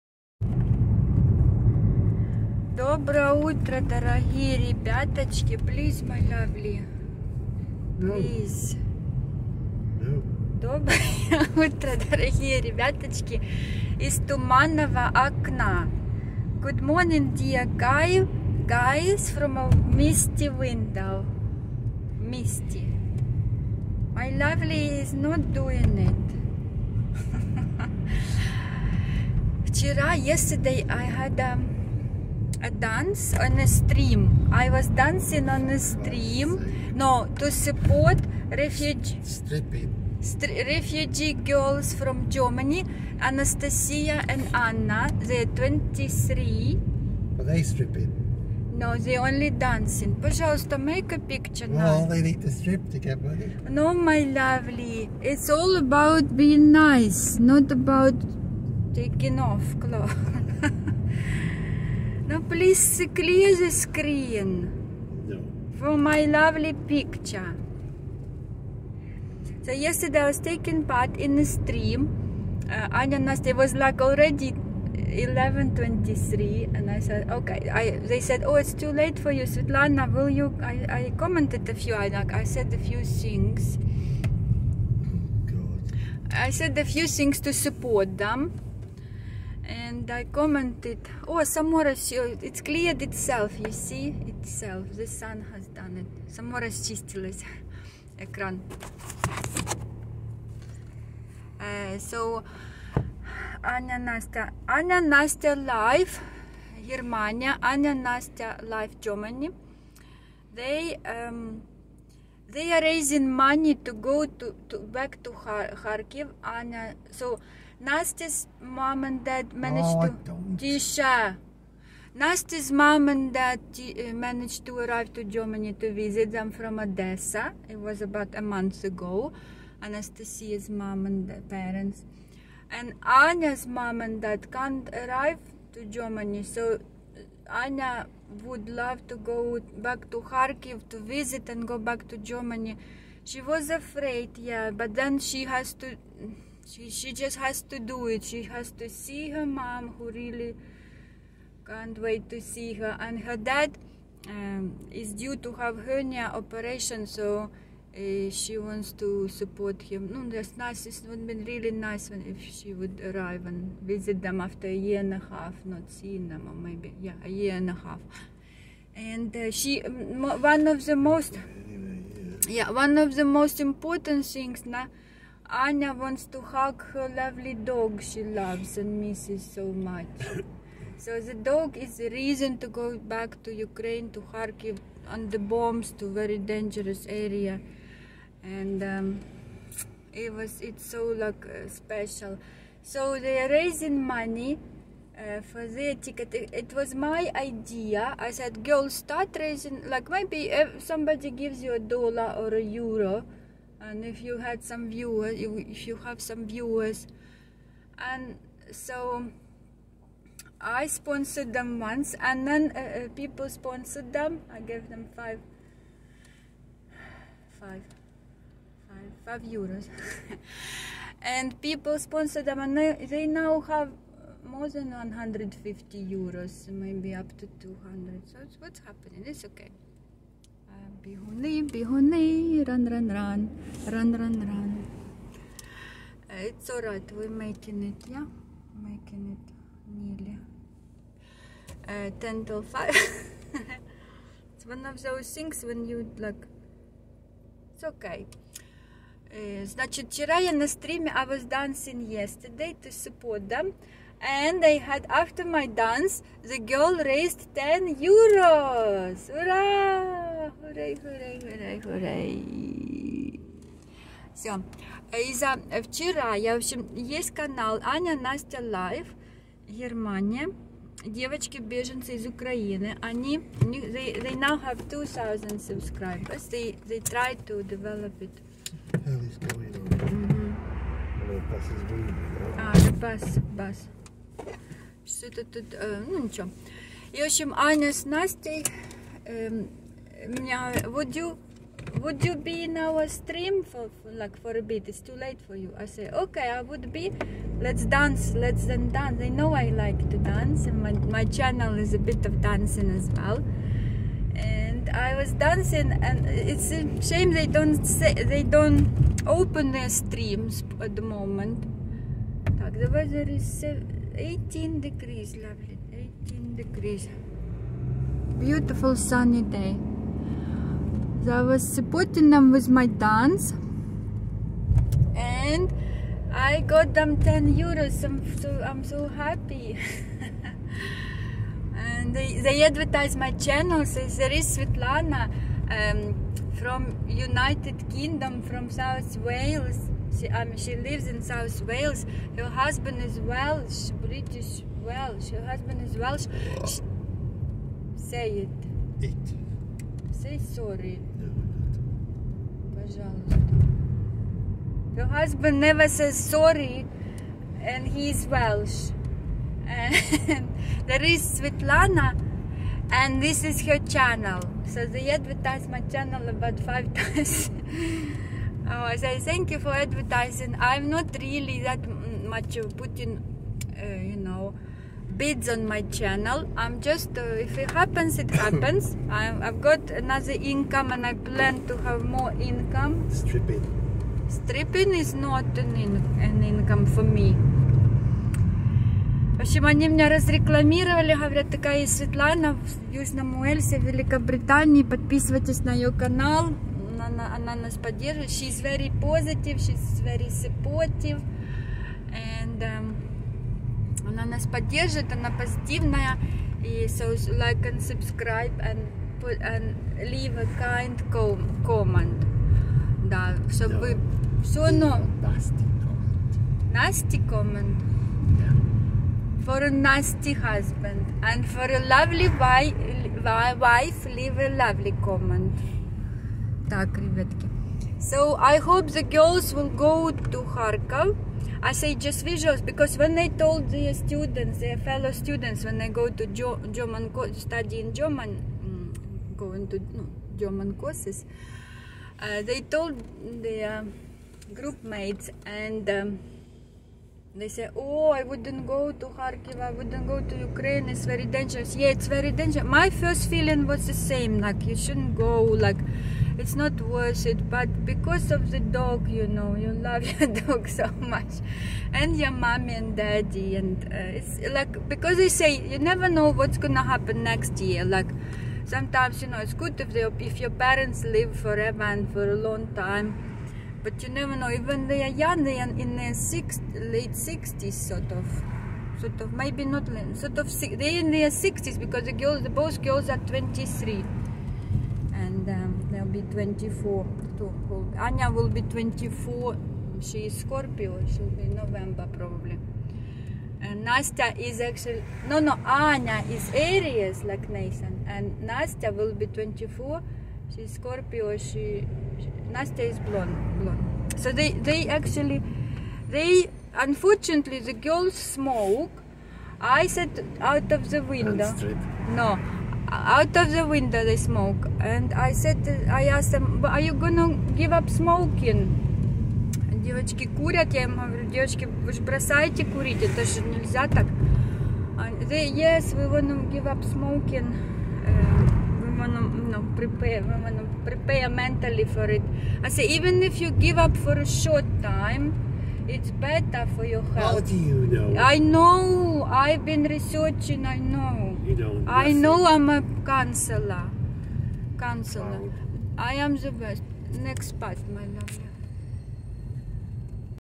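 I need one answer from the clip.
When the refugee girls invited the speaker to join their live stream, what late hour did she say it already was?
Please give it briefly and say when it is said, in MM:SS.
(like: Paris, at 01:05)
11.23, at 01:14.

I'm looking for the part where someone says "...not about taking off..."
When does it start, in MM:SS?
00:57.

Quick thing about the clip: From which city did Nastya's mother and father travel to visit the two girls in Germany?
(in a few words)
Odessa.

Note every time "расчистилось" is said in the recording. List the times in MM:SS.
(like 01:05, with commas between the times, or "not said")
01:36.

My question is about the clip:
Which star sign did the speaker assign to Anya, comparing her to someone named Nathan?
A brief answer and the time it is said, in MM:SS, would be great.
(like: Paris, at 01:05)
Aries, at 08:16.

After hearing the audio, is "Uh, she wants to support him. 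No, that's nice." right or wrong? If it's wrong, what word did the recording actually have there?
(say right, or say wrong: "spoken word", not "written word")
right.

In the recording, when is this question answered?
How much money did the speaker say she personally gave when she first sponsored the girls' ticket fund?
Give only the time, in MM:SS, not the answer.
03:39.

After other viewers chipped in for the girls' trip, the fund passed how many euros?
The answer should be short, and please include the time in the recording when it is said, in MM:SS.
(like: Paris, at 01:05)
150, at 03:44.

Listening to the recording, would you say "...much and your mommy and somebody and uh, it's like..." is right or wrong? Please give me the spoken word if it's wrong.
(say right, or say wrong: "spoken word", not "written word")
wrong: "daddy", not "somebody".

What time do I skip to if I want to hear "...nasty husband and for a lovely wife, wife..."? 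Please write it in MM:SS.
06:59.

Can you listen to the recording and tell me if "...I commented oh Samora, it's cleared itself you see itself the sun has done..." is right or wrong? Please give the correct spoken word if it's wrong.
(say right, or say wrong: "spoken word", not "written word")
right.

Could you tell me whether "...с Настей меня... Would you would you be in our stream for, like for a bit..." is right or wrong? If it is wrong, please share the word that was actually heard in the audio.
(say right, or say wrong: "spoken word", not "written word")
right.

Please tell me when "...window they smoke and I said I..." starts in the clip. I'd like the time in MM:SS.
08:33.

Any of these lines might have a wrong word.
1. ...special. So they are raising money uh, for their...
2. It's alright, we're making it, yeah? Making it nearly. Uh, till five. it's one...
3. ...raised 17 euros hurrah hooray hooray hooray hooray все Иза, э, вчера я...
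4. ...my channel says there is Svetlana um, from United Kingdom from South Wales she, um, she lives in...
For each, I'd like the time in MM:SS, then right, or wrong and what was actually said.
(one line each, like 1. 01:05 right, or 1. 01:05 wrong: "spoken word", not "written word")
1. 03:11 right
2. 03:56 right
3. 04:17 wrong: "10", not "17"
4. 05:33 right.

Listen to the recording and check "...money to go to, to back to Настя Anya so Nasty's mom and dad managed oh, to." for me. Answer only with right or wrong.
wrong.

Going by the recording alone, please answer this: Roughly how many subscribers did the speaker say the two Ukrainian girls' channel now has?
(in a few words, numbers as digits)
2000.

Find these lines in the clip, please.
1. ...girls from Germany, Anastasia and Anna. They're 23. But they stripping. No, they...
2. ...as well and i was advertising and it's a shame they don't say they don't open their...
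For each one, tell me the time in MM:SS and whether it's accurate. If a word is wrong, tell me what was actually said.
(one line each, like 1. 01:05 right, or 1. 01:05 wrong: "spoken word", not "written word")
1. 00:41 right
2. 05:02 wrong: "dancing", not "advertising".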